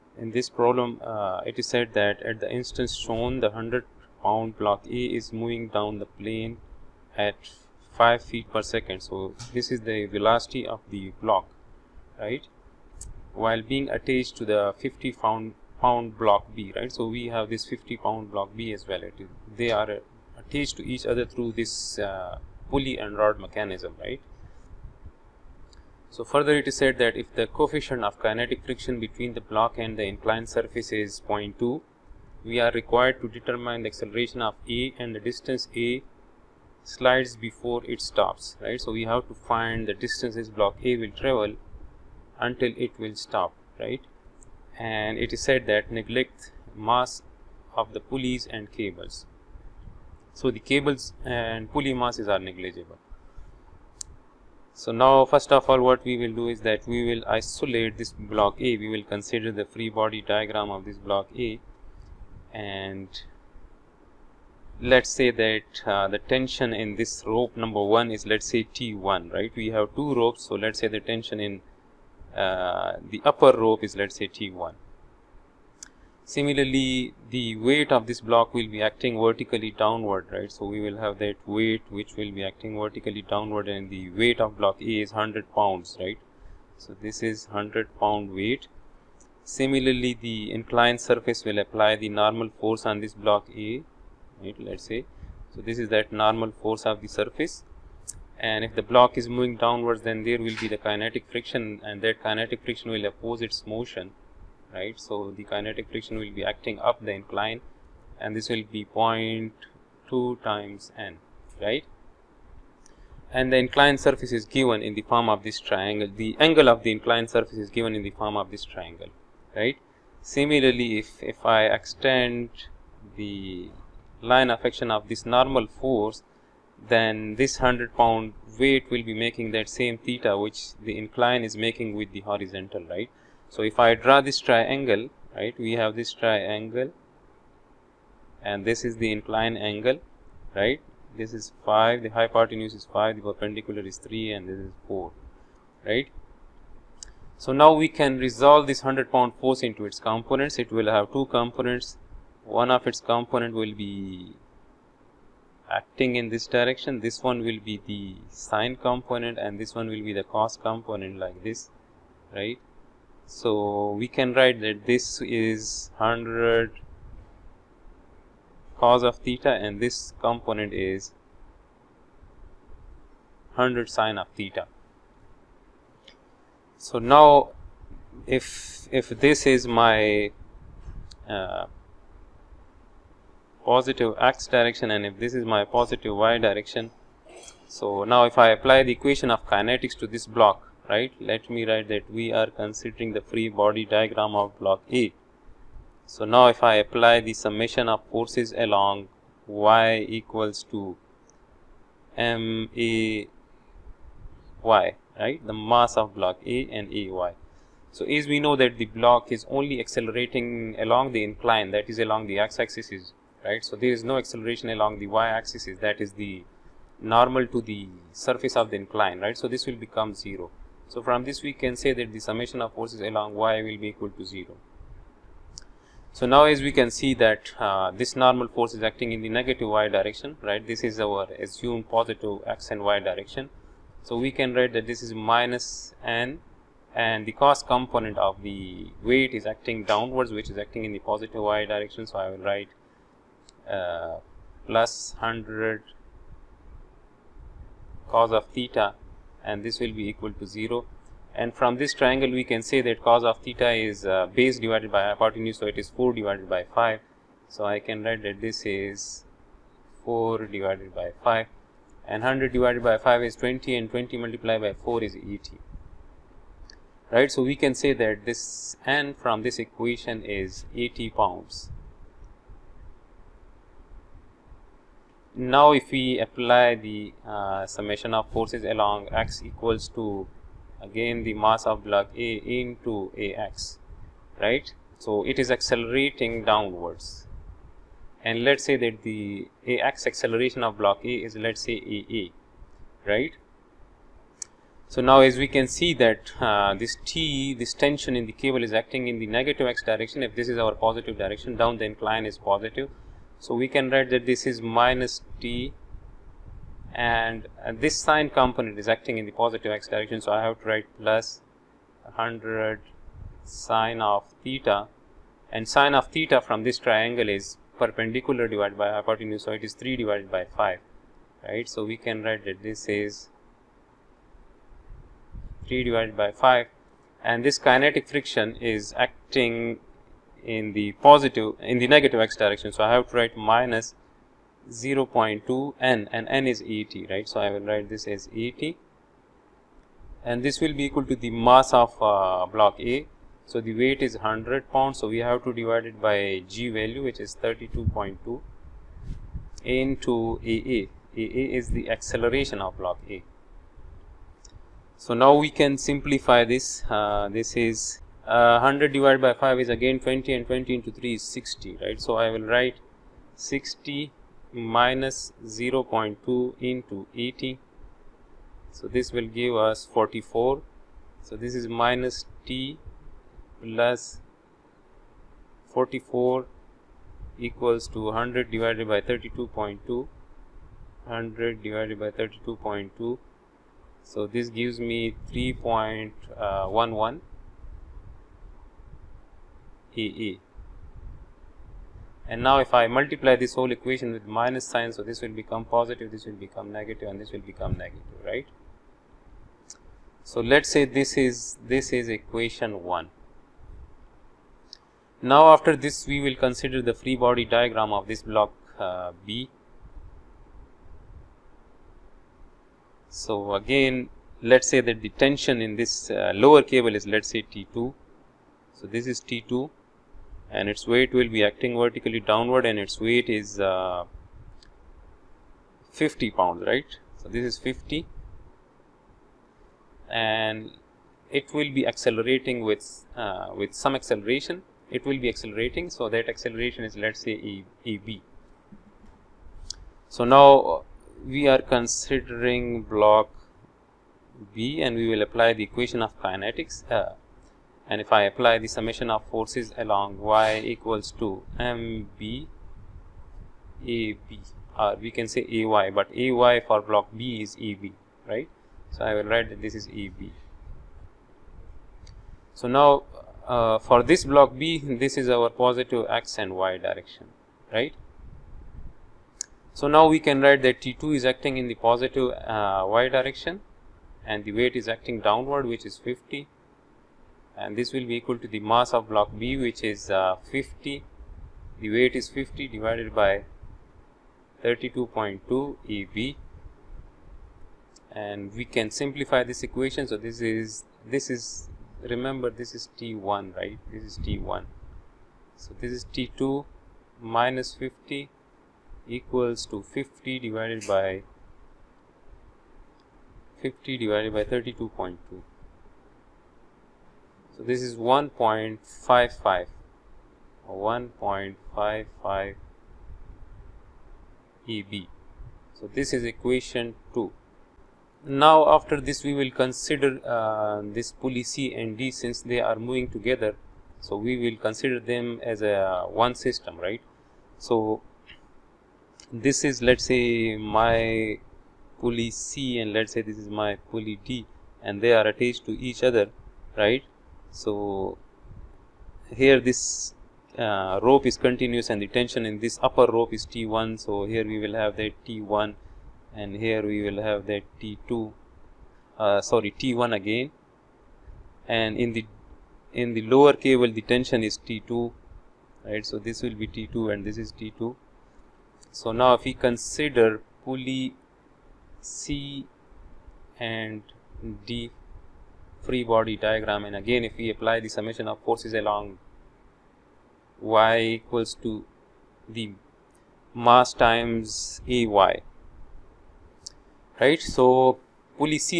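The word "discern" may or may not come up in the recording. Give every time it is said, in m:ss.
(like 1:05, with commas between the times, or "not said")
not said.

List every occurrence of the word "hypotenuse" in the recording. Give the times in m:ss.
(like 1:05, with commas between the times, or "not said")
2:22, 4:15, 5:18.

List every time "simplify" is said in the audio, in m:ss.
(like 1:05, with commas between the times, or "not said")
5:55, 8:08.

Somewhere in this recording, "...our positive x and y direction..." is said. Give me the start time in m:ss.
7:45.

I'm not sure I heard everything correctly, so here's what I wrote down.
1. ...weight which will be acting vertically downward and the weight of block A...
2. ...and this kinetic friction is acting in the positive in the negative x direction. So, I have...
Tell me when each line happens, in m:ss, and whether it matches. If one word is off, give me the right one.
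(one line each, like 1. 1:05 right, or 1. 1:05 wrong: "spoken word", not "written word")
1. 1:21 right
2. 5:27 right.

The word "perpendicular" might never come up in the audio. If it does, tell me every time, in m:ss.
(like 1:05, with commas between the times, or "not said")
2:23, 5:17.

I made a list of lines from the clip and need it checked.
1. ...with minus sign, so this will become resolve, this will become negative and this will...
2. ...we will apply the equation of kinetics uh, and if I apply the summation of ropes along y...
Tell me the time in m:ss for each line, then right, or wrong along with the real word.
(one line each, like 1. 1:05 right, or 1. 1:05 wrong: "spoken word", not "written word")
1. 6:34 wrong: "positive", not "resolve"
2. 7:24 wrong: "forces", not "ropes".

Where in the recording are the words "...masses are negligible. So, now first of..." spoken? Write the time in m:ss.
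0:51.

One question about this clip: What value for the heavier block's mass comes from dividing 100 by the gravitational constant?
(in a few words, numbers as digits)
3.11.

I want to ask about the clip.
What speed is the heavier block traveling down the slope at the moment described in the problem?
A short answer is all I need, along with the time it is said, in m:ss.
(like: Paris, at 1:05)
5 feet per second, at 0:08.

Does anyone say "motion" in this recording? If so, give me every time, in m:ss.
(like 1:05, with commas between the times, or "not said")
1:43.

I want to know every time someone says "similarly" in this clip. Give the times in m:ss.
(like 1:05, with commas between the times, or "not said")
1:16, 1:29, 2:00.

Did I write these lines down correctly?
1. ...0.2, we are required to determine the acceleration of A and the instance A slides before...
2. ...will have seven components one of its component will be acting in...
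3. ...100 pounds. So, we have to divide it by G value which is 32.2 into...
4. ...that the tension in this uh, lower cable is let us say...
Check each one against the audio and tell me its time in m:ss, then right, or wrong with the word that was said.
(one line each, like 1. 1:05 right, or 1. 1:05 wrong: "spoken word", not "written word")
1. 0:31 wrong: "distance", not "instance"
2. 2:30 wrong: "two", not "seven"
3. 5:44 right
4. 6:54 right.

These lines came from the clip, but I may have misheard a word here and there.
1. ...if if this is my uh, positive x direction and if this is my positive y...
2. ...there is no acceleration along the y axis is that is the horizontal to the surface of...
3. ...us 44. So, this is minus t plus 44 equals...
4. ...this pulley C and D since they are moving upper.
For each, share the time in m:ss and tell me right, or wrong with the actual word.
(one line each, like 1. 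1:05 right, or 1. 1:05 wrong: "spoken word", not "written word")
1. 2:58 right
2. 3:33 wrong: "normal", not "horizontal"
3. 6:09 right
4. 8:40 wrong: "together", not "upper".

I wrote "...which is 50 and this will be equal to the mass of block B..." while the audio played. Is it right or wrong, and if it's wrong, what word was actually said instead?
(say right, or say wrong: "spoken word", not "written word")
right.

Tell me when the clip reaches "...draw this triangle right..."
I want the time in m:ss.
2:13.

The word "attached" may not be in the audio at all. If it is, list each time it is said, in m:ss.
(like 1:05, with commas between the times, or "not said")
0:13, 0:20, 8:55.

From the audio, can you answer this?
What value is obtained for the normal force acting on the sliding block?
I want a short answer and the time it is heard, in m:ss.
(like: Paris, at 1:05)
80 pounds, at 4:30.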